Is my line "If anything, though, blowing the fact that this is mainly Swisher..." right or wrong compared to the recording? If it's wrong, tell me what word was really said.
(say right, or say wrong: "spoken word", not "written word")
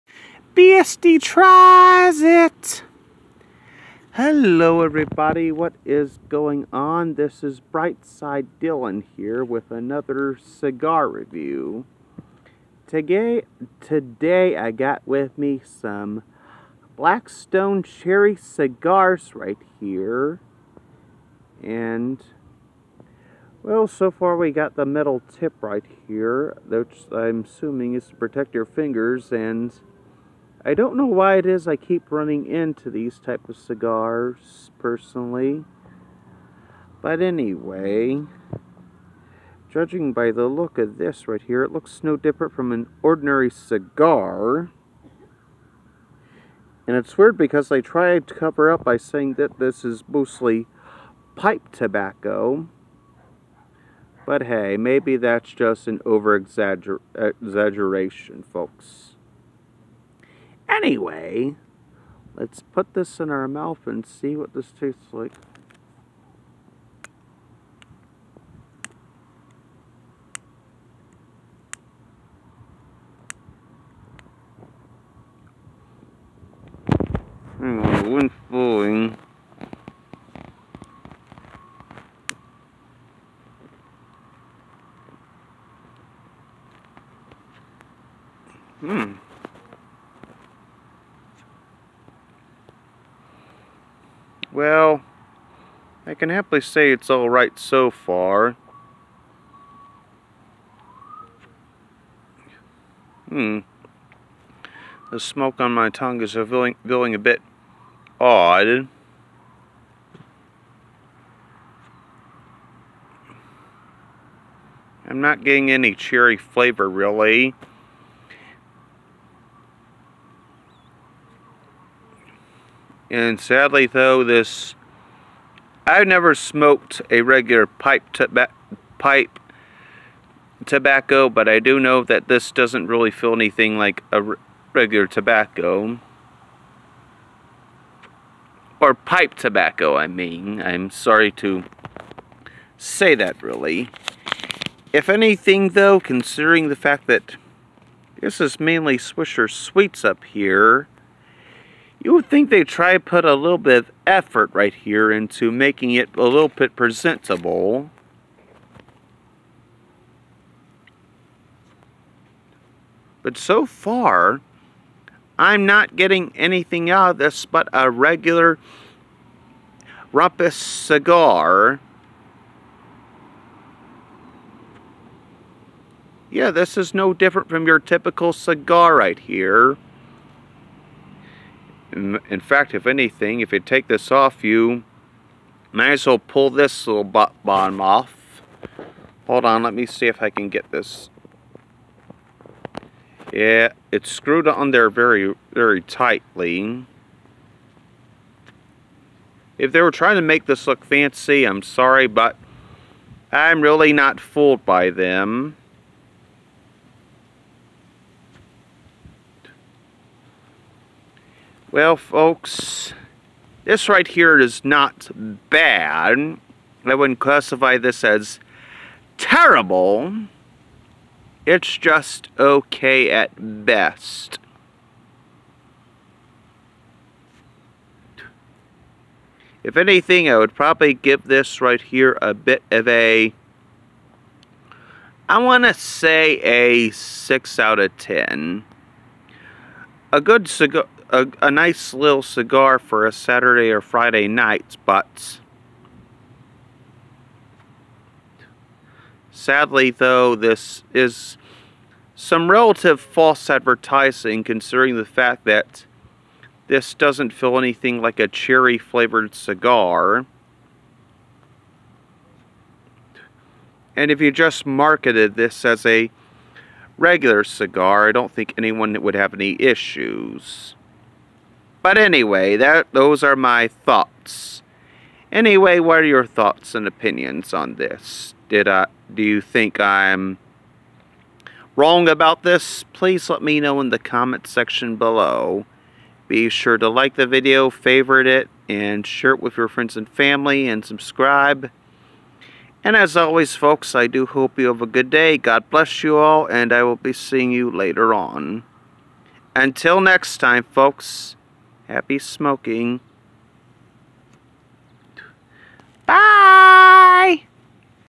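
wrong: "considering", not "blowing".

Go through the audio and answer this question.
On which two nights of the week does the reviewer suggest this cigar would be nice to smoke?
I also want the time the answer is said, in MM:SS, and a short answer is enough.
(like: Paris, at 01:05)
Saturday or Friday, at 04:03.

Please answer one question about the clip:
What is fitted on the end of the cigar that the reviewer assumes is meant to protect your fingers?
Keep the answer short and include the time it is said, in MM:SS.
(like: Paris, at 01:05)
metal tip, at 00:24.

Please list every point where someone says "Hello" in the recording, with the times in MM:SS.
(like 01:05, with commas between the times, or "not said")
00:04.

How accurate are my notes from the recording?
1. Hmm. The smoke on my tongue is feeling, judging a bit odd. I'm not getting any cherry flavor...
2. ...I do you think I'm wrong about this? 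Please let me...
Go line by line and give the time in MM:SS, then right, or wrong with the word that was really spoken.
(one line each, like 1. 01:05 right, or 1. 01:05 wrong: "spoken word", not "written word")
1. 01:43 wrong: "feeling", not "judging"
2. 04:38 right.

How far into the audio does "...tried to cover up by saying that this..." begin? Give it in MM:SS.
00:47.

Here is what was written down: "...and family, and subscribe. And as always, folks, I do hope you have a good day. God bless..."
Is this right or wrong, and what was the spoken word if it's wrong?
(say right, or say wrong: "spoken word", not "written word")
right.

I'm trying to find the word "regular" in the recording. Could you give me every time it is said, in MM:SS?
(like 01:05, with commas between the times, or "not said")
02:07, 02:14, 02:47, 04:26.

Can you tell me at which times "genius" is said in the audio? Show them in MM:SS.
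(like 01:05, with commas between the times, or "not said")
not said.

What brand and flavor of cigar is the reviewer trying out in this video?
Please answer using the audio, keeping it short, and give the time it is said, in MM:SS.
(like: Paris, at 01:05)
Blackstone Cherry, at 00:16.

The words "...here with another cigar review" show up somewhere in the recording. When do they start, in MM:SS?
00:09.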